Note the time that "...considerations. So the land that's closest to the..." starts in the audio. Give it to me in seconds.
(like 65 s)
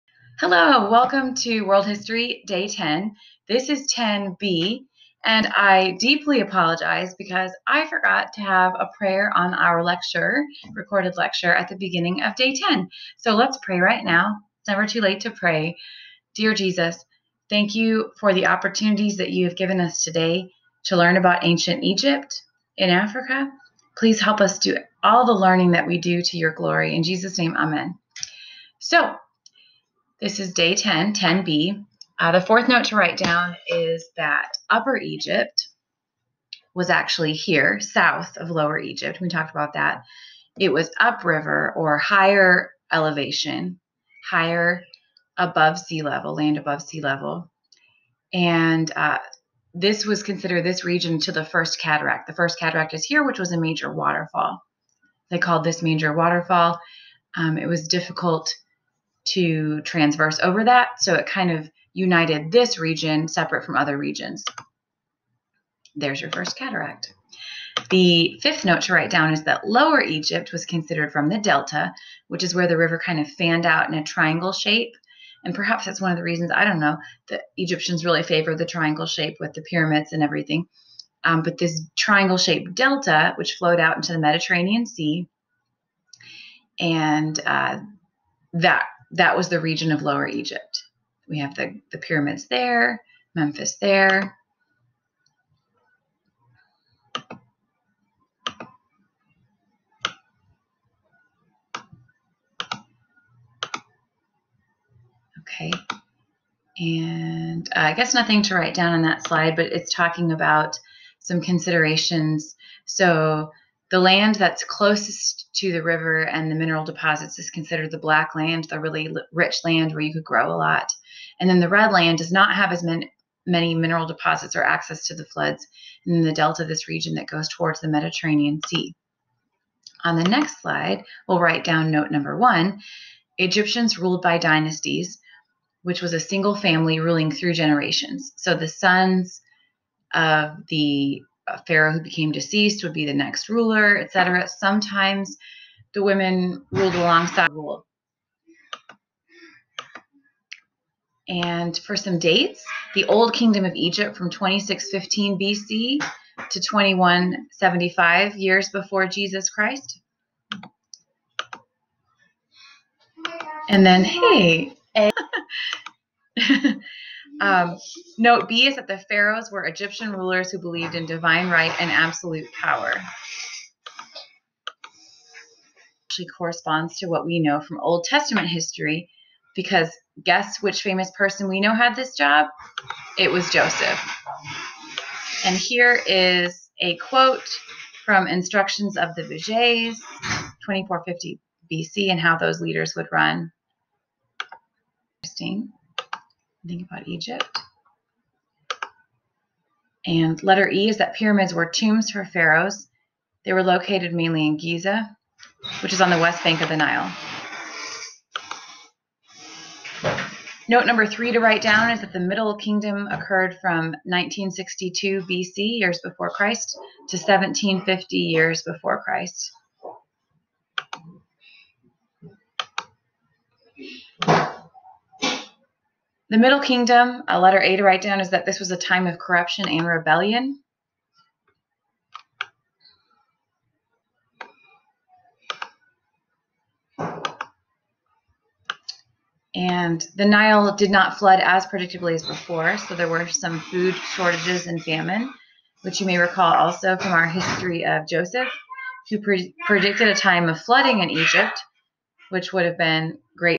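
111 s.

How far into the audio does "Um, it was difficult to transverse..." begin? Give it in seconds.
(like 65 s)
57 s.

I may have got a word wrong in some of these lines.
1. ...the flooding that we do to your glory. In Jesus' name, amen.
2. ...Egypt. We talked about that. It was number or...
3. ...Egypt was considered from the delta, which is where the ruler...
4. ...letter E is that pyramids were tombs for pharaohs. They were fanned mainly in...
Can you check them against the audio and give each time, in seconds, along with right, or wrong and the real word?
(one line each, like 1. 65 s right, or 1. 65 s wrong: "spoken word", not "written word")
1. 25 s wrong: "learning", not "flooding"
2. 38 s wrong: "upriver", not "number"
3. 70 s wrong: "river", not "ruler"
4. 200 s wrong: "located", not "fanned".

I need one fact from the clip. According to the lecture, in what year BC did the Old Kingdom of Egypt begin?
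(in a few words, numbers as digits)
2615 BC.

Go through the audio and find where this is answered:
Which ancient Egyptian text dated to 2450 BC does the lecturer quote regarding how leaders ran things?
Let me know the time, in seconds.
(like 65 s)
188 s.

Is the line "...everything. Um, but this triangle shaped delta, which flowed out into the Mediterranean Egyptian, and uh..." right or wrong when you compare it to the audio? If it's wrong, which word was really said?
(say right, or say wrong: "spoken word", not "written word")
wrong: "Sea", not "Egyptian".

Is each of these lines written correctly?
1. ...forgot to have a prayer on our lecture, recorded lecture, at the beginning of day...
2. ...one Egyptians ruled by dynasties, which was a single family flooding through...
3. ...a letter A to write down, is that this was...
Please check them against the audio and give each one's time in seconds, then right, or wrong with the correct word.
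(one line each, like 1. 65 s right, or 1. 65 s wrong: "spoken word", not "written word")
1. 7 s right
2. 132 s wrong: "ruling", not "flooding"
3. 227 s right.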